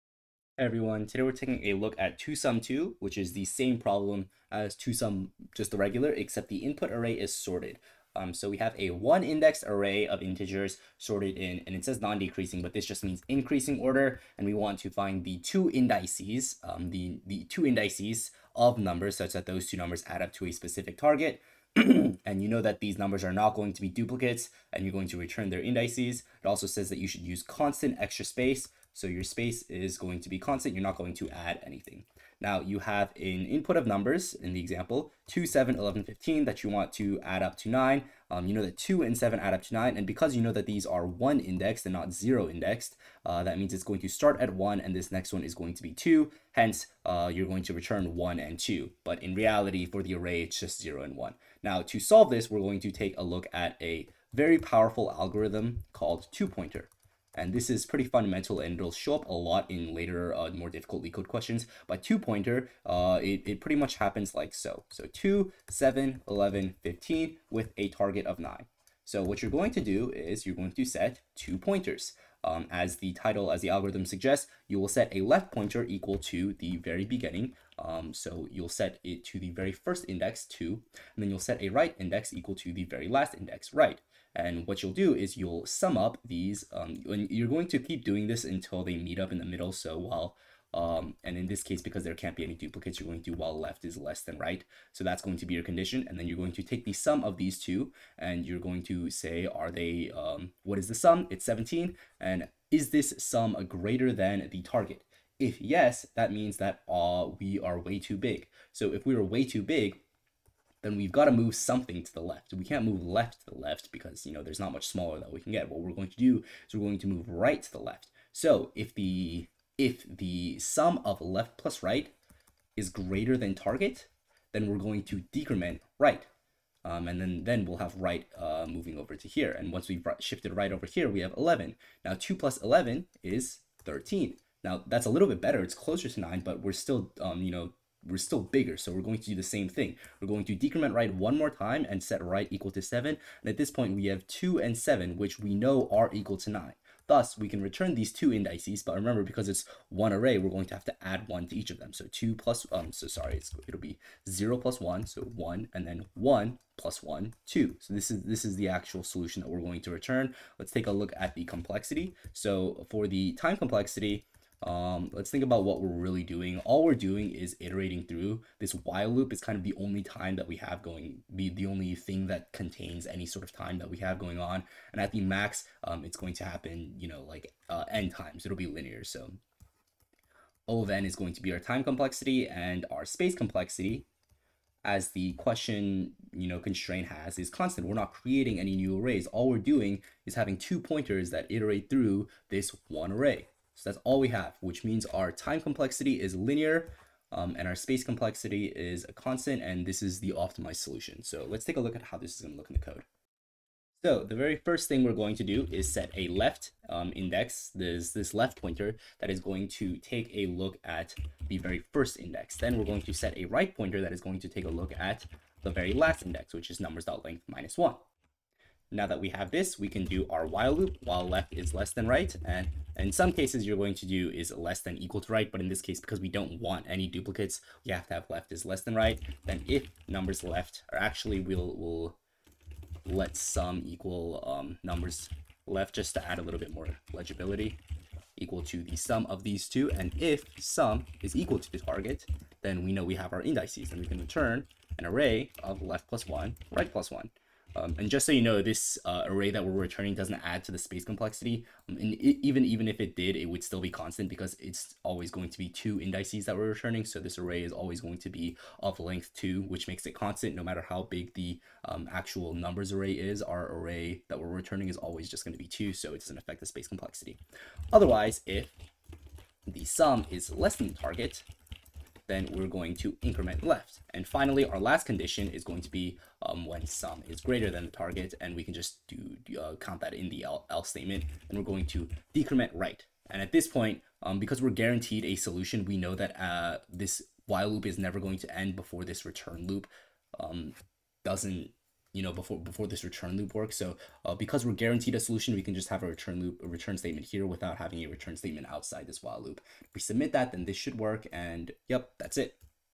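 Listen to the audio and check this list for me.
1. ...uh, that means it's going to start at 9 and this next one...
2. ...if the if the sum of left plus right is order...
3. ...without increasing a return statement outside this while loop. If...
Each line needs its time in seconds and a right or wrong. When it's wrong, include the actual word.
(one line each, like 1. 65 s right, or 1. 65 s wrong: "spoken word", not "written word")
1. 43 s wrong: "1", not "9"
2. 118 s wrong: "greater", not "order"
3. 297 s wrong: "having", not "increasing".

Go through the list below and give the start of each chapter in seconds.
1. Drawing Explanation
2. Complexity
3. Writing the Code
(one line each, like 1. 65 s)
1. 55 s
2. 160 s
3. 203 s.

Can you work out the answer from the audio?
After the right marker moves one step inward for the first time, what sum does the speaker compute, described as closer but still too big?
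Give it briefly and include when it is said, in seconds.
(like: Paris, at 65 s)
13, at 132 s.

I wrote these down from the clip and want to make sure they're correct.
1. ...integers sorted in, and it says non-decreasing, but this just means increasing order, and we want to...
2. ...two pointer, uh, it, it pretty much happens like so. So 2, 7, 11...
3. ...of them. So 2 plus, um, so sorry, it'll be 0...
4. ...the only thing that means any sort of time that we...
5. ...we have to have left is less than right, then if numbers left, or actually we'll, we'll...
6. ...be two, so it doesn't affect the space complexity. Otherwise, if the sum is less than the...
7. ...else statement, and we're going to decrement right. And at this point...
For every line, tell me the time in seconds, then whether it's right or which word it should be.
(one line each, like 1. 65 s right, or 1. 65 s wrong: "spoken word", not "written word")
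1. 10 s right
2. 62 s right
3. 151 s right
4. 171 s wrong: "contains", not "means"
5. 227 s right
6. 265 s right
7. 280 s right.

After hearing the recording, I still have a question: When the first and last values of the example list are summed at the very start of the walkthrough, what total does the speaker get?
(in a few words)
17.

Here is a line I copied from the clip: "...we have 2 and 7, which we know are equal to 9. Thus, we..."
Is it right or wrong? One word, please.
right.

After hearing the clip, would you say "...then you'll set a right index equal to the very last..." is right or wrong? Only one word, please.
right.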